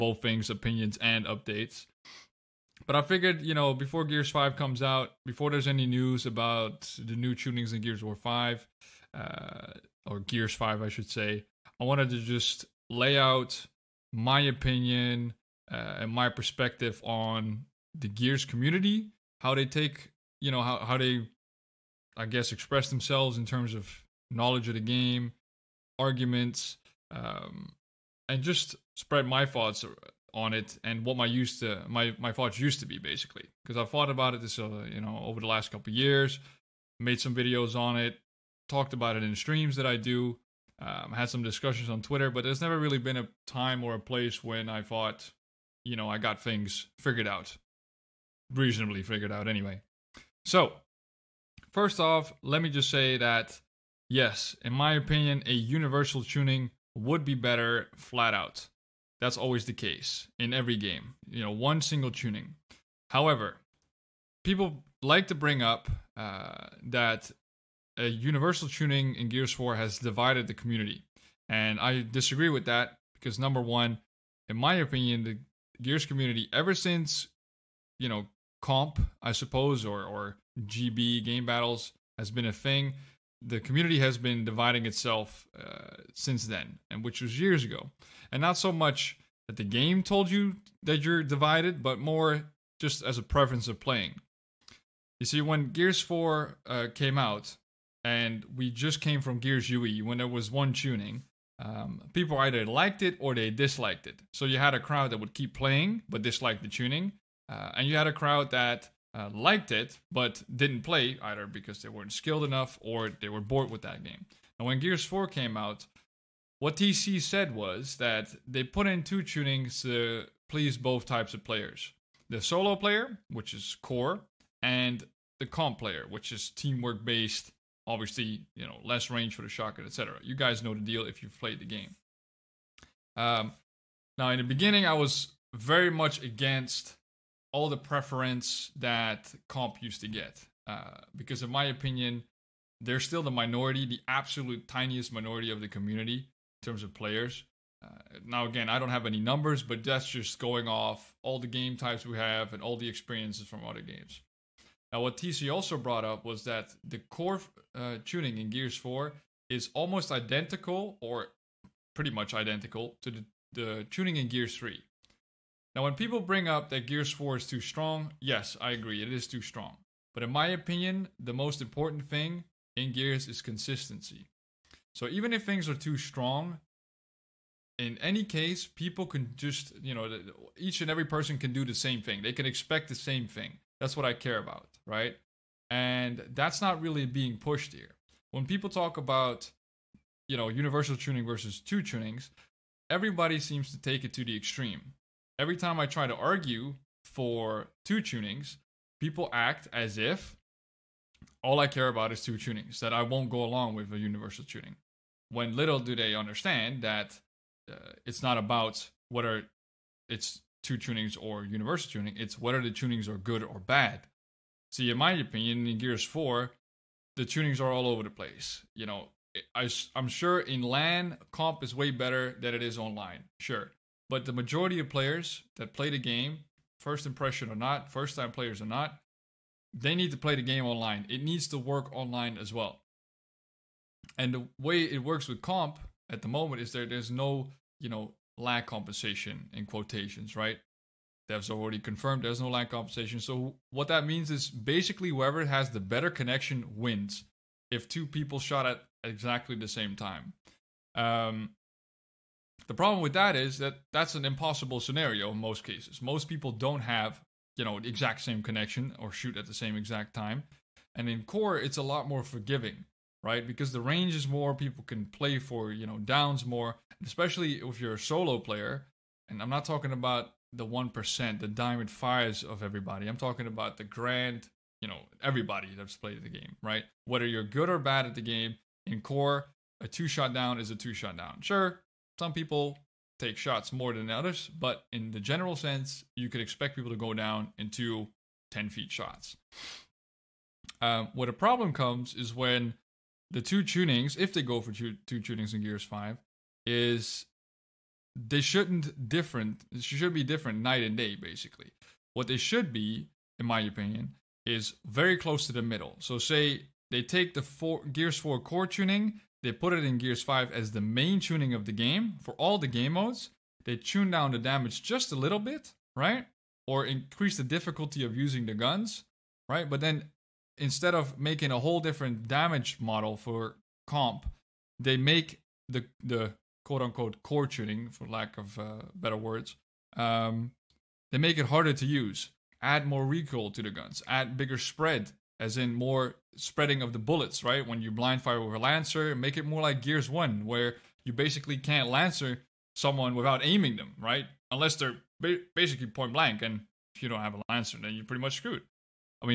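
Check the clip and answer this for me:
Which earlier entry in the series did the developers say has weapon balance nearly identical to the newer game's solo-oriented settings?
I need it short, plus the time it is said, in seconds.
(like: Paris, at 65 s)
Gears 3, at 164 s.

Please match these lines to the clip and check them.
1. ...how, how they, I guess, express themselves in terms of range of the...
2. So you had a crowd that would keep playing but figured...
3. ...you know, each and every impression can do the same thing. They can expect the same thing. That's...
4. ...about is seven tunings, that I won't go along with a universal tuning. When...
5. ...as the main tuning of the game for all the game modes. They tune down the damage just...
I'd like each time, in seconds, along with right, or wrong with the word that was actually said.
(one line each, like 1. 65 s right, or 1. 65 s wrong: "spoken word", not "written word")
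1. 20 s wrong: "knowledge", not "range"
2. 104 s wrong: "disliked", not "figured"
3. 179 s wrong: "person", not "impression"
4. 201 s wrong: "two", not "seven"
5. 310 s right.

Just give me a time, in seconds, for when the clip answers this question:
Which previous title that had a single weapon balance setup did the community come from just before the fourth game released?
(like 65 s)
99 s.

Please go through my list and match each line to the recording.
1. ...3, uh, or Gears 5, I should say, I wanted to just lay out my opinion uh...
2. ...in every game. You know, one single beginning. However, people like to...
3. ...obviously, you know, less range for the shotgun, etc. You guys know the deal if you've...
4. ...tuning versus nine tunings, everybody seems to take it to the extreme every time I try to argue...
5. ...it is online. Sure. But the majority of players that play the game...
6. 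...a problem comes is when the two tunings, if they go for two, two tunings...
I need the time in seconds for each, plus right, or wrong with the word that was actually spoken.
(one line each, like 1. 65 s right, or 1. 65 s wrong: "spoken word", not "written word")
1. 8 s wrong: "5", not "3"
2. 60 s wrong: "tuning", not "beginning"
3. 127 s right
4. 190 s wrong: "two", not "nine"
5. 222 s right
6. 291 s right.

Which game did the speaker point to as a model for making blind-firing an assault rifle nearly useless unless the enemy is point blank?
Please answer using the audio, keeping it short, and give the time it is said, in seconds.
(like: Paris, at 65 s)
Gears 1, at 339 s.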